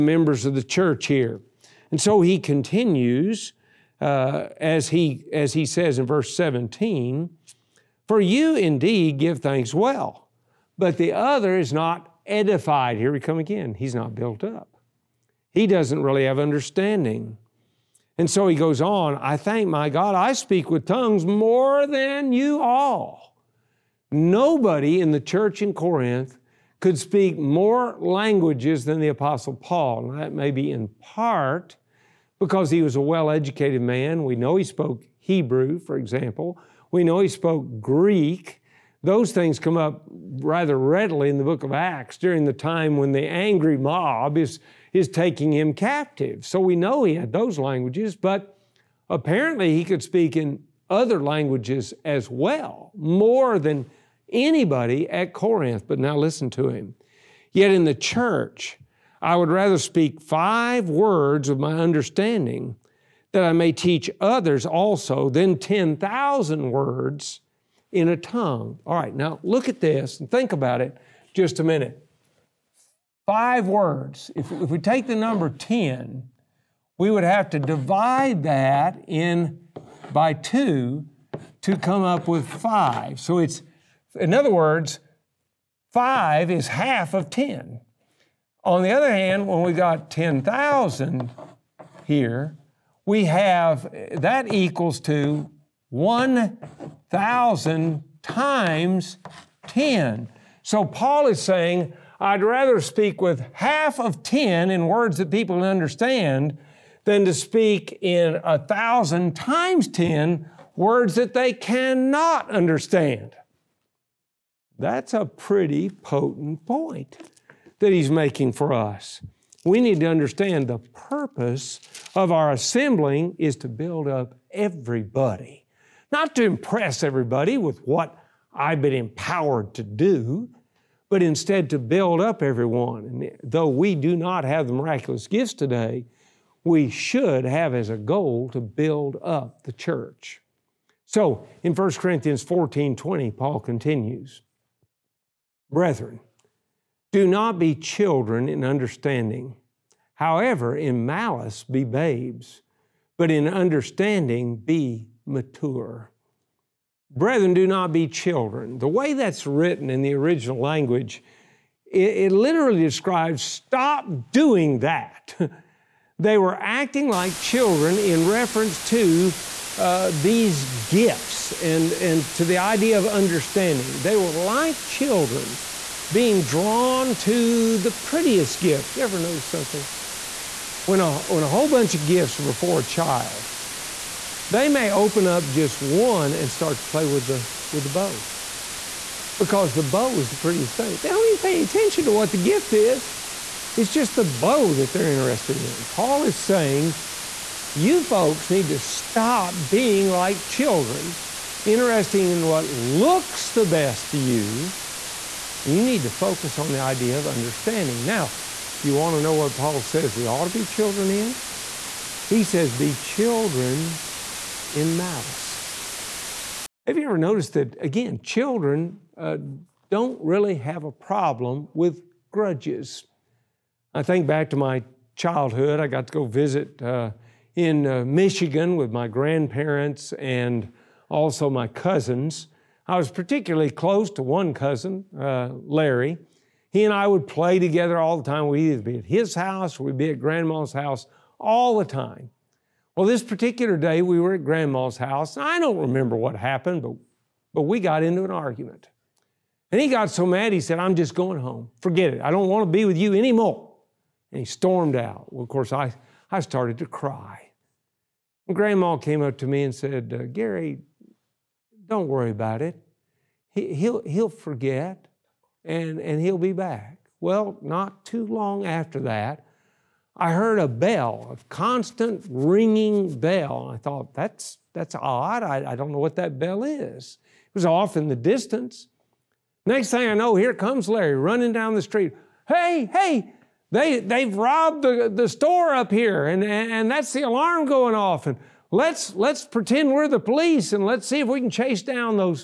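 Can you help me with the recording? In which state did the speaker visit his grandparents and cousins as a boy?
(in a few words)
Michigan.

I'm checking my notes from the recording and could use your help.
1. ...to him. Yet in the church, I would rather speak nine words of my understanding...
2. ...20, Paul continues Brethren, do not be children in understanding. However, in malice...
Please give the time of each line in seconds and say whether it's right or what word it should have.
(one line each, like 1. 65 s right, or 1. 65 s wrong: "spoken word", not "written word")
1. 56 s wrong: "five", not "nine"
2. 142 s right.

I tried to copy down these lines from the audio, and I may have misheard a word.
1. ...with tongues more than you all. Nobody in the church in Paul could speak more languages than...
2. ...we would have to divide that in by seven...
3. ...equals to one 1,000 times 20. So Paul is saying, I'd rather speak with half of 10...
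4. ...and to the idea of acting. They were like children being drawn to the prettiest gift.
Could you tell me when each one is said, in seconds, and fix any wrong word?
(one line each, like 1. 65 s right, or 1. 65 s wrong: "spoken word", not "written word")
1. 20 s wrong: "Corinth", not "Paul"
2. 76 s wrong: "two", not "seven"
3. 94 s wrong: "10", not "20"
4. 171 s wrong: "understanding", not "acting".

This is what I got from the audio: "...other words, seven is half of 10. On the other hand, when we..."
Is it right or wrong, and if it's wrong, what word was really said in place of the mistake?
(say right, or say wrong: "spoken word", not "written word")
wrong: "five", not "seven".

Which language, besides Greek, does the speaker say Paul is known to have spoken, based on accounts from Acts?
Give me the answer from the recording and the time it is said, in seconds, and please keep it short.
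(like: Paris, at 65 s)
Hebrew, at 35 s.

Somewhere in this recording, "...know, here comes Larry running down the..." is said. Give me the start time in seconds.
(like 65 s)
280 s.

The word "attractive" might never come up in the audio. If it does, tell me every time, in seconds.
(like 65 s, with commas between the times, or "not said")
not said.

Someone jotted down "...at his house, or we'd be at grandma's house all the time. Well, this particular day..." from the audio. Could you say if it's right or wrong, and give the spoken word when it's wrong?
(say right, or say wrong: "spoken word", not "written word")
right.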